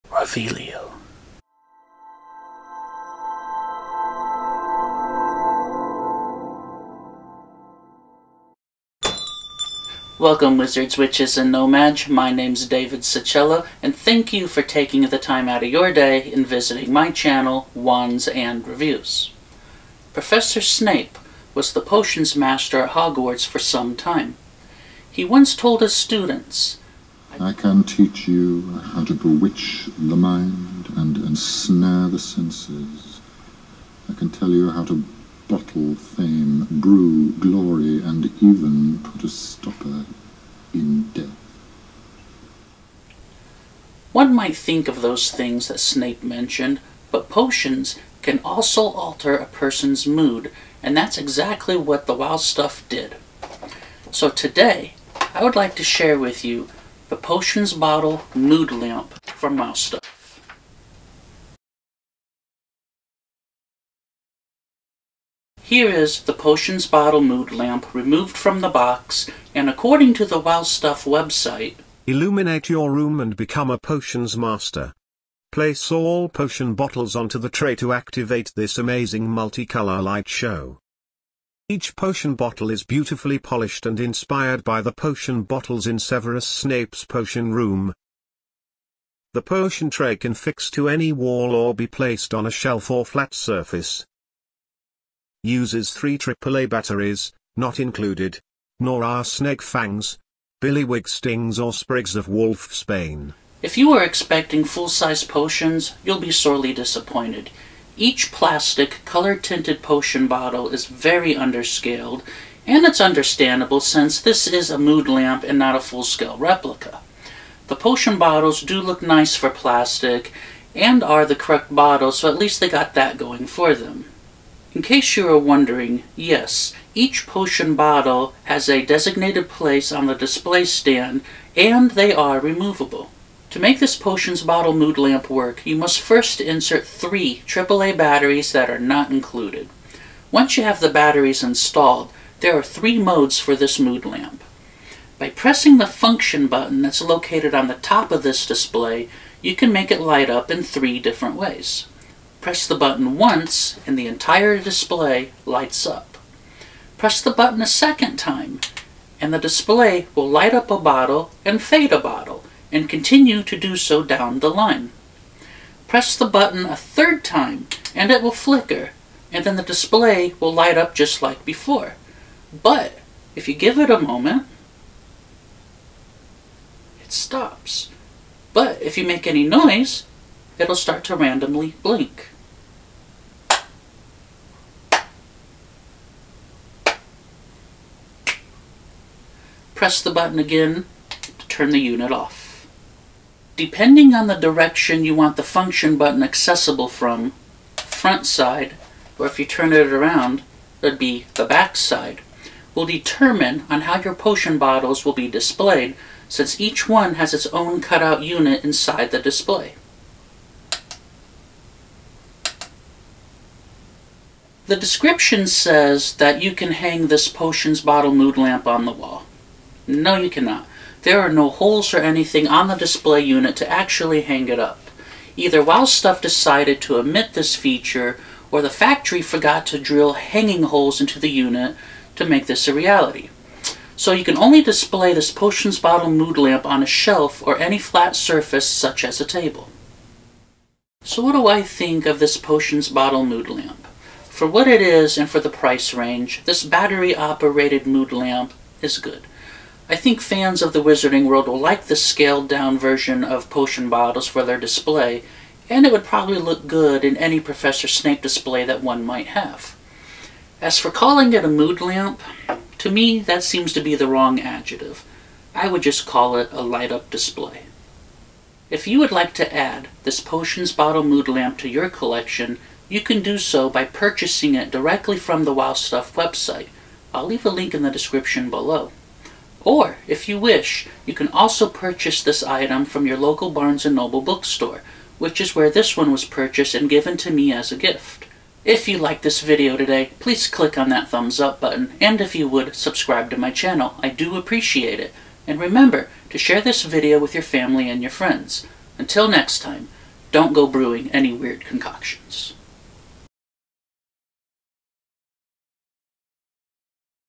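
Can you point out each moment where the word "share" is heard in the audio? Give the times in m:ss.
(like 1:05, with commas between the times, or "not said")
0:55, 4:56.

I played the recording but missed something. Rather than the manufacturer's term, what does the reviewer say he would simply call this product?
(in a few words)
light-up display.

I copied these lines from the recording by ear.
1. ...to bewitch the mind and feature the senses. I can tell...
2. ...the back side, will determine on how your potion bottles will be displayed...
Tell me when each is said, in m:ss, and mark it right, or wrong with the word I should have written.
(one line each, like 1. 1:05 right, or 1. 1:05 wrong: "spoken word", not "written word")
1. 0:29 wrong: "ensnare", not "feature"
2. 3:21 right.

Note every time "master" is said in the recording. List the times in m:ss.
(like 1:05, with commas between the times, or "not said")
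0:22, 1:14.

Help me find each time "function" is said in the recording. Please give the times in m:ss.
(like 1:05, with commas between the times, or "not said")
2:25, 3:15.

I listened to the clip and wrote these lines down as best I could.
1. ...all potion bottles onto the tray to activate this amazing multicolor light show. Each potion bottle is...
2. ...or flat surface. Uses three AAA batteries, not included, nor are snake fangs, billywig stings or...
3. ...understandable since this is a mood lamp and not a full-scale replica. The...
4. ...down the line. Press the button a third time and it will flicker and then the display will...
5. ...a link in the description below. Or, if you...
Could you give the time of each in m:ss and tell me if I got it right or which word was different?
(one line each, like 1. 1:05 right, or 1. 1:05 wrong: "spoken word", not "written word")
1. 1:15 right
2. 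1:32 right
3. 1:53 right
4. 2:44 right
5. 4:37 right.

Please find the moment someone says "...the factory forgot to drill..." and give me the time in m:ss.
3:48.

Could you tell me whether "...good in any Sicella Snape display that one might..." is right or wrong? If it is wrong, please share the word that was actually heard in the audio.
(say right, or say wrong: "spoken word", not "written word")
wrong: "Professor", not "Sicella".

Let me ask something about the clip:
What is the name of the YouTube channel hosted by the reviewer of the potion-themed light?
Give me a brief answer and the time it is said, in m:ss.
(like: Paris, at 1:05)
Wands and Reviews, at 0:17.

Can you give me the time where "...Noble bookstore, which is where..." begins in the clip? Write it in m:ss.
4:43.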